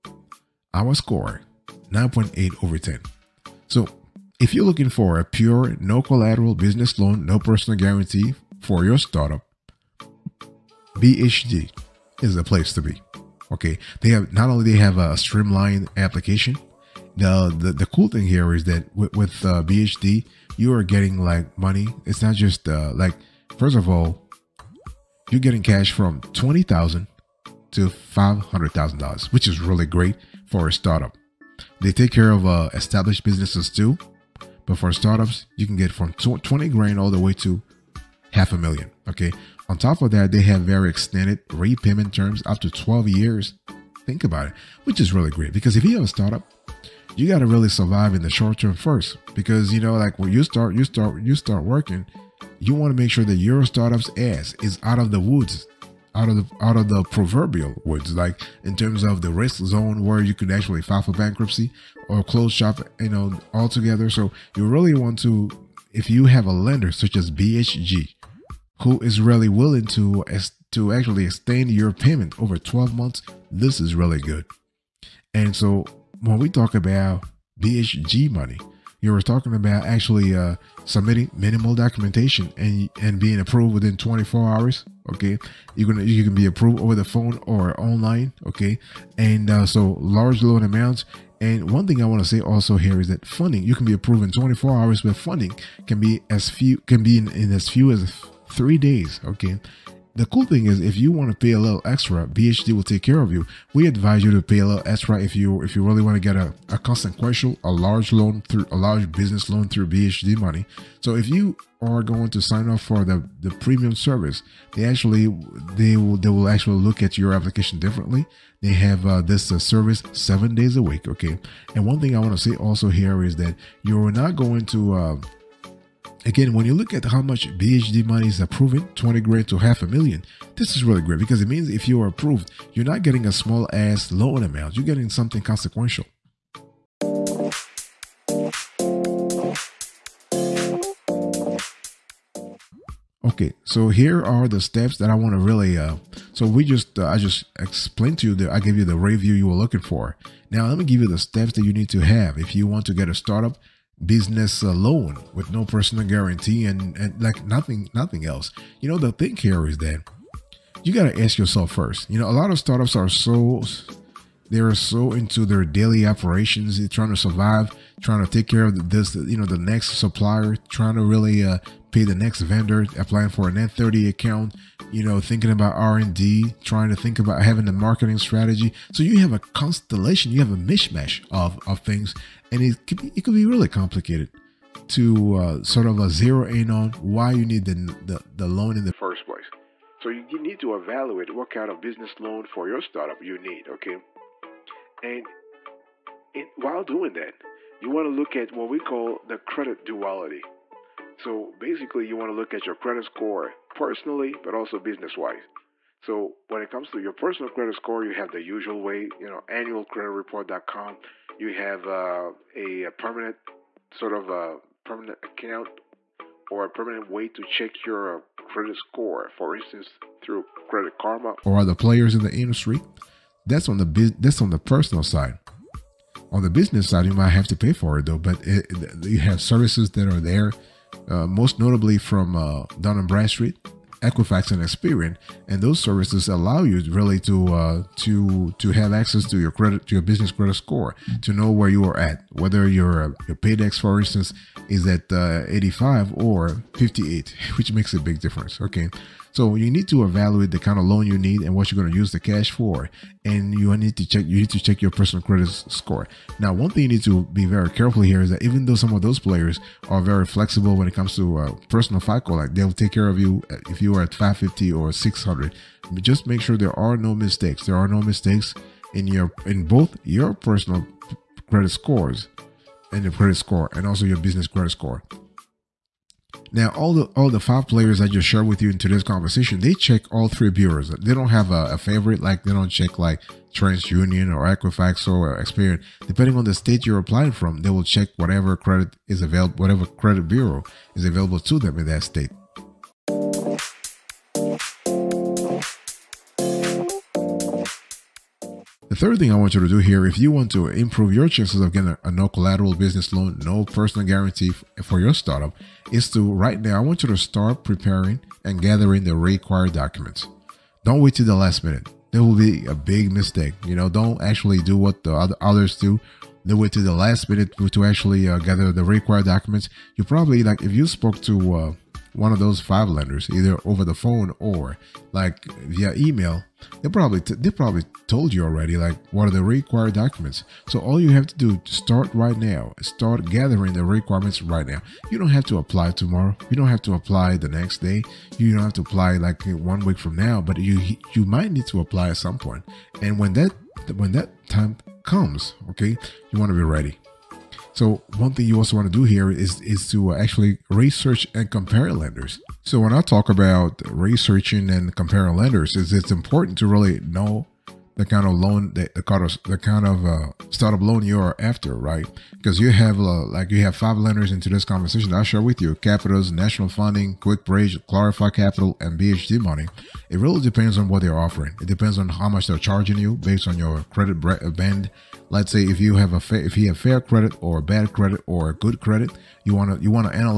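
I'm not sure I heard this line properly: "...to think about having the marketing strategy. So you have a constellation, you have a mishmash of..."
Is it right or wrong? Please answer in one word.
right.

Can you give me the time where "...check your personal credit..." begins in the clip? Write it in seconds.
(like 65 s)
254 s.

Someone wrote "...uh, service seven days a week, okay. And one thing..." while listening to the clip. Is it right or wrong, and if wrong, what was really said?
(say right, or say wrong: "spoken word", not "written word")
right.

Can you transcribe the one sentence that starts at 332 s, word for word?
Start gathering the requirements right now.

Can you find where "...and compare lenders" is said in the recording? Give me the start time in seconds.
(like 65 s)
351 s.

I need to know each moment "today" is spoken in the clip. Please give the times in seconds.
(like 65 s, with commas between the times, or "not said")
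278 s.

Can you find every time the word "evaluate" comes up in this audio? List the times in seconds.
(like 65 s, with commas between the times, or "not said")
190 s, 250 s.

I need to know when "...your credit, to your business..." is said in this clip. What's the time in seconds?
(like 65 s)
239 s.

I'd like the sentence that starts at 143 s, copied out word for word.
Okay, so here are the steps that I want to really.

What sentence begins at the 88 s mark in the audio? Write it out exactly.
Okay, and uh, so large loan amounts.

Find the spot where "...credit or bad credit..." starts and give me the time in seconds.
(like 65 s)
377 s.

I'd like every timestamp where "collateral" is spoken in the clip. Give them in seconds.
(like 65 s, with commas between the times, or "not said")
6 s, 302 s.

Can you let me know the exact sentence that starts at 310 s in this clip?
Don't wait till the last minute.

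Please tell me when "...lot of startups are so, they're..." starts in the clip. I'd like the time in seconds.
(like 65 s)
162 s.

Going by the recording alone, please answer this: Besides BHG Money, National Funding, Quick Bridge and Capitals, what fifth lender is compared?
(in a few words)
Clarify Capital.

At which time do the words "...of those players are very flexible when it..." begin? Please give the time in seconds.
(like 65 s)
258 s.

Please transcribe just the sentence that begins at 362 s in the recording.
Because you have uh, like you have five lenders into this conversation.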